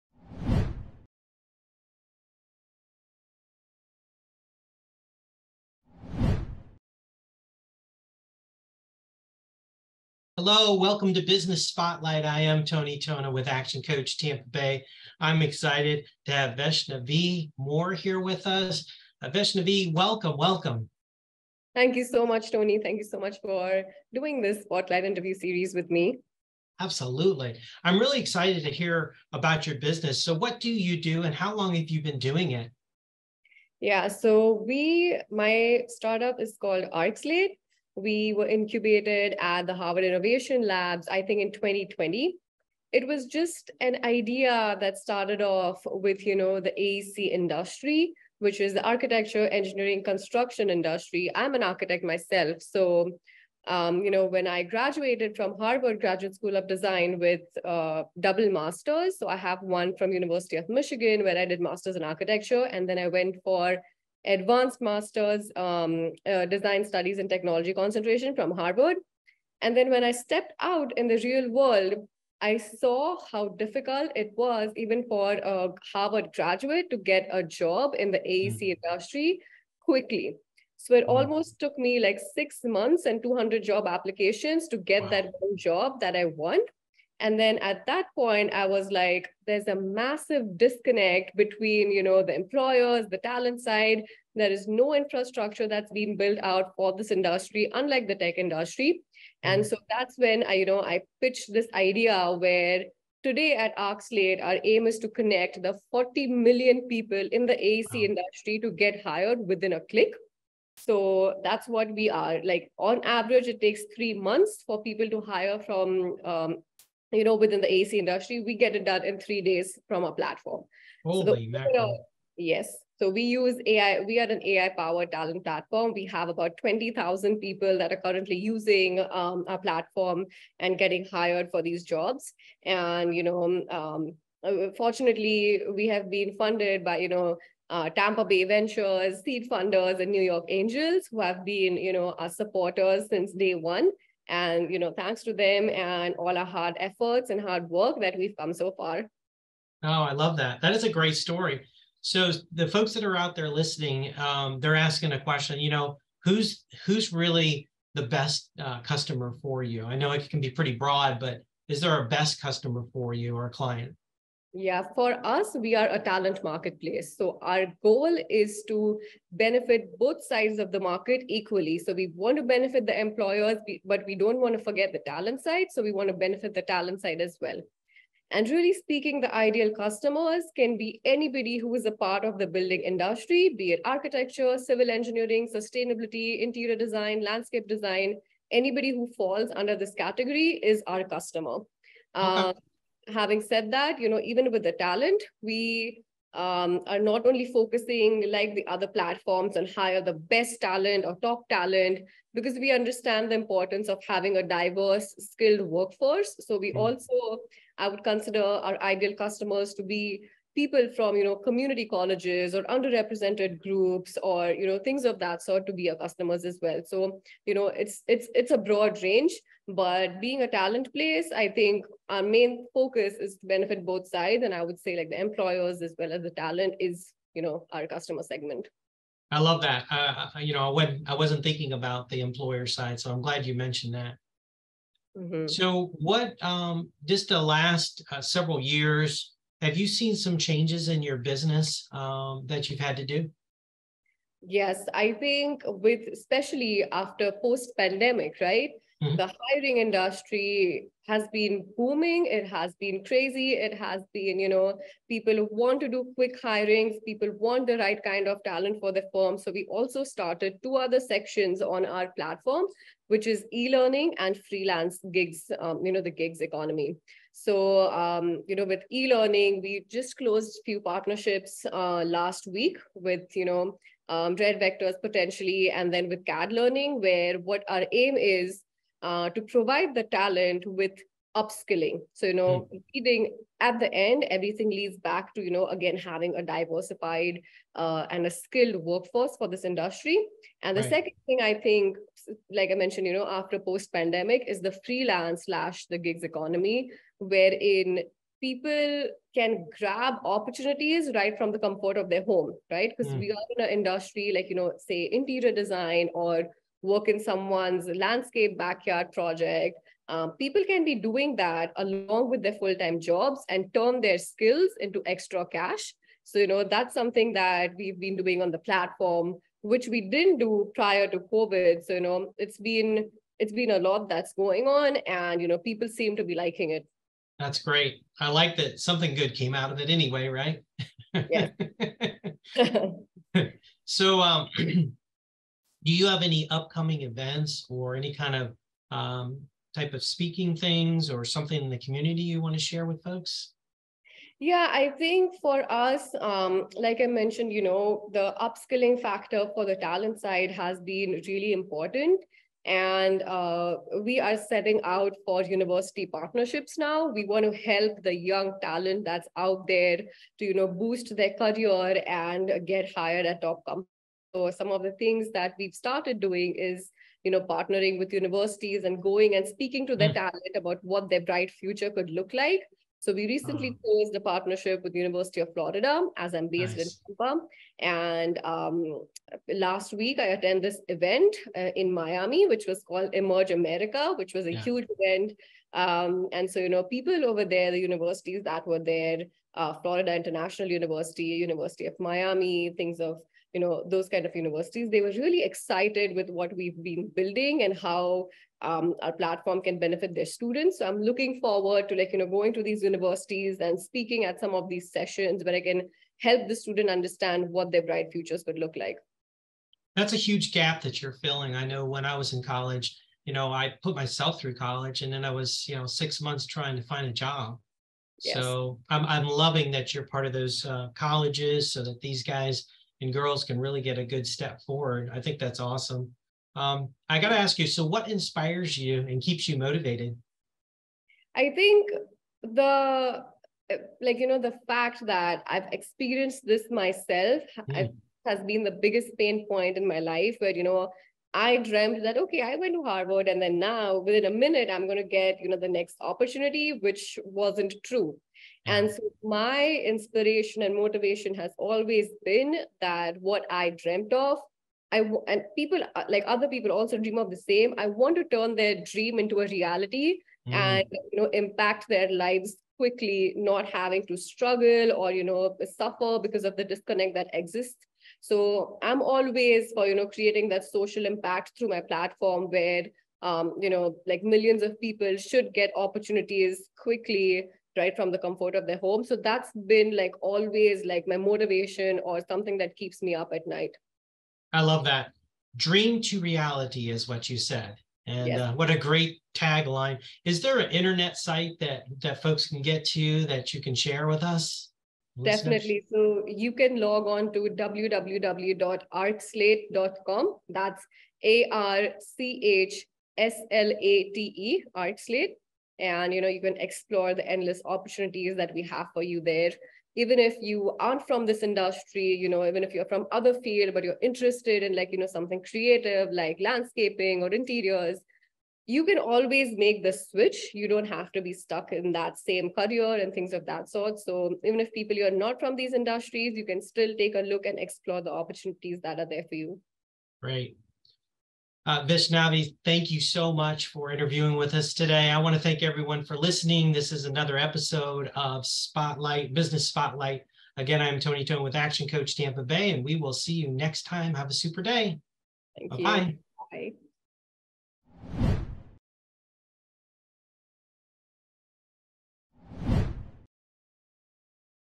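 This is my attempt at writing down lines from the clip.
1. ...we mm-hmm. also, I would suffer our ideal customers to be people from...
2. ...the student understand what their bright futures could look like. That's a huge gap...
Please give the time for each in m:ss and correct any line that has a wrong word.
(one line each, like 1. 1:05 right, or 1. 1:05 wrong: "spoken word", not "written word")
1. 3:26 wrong: "consider", not "suffer"
2. 6:46 right.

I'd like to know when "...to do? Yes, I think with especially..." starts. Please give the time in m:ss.
4:02.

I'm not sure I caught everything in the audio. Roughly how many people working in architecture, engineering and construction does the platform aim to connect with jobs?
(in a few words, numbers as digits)
40 million.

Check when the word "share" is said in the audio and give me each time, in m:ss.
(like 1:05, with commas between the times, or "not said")
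5:42, 8:13.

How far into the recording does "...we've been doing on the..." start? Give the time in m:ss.
5:17.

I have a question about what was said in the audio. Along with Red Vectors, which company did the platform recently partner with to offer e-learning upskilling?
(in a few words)
CAD Learning.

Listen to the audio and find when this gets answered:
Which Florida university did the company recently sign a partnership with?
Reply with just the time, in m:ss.
6:14.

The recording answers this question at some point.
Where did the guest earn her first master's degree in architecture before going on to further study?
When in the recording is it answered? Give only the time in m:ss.
1:00.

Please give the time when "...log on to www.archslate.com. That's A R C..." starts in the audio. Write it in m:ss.
8:16.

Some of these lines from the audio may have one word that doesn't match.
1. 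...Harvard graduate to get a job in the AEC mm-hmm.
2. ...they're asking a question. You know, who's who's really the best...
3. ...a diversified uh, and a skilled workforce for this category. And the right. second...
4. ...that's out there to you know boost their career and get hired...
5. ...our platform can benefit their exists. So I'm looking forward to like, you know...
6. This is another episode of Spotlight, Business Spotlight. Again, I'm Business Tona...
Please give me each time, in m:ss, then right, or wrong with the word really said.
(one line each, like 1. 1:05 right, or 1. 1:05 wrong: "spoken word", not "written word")
1. 1:15 right
2. 2:34 right
3. 4:46 wrong: "industry", not "category"
4. 5:59 right
5. 6:39 wrong: "students", not "exists"
6. 8:56 wrong: "Tony", not "Business".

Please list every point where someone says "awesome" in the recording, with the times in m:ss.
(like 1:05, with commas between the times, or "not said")
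7:05.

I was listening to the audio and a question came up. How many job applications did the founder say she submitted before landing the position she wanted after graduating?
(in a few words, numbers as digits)
200.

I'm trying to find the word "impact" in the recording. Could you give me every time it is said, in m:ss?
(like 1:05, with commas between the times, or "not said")
7:41, 7:51.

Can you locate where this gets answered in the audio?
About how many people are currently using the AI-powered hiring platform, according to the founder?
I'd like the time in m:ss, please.
2:06.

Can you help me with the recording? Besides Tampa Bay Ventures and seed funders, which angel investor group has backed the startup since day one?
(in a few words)
New York Angels.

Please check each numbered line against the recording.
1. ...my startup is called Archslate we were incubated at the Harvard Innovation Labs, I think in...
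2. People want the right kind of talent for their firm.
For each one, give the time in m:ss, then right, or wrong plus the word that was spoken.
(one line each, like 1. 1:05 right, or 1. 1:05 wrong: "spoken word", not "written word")
1. 0:35 right
2. 4:17 right.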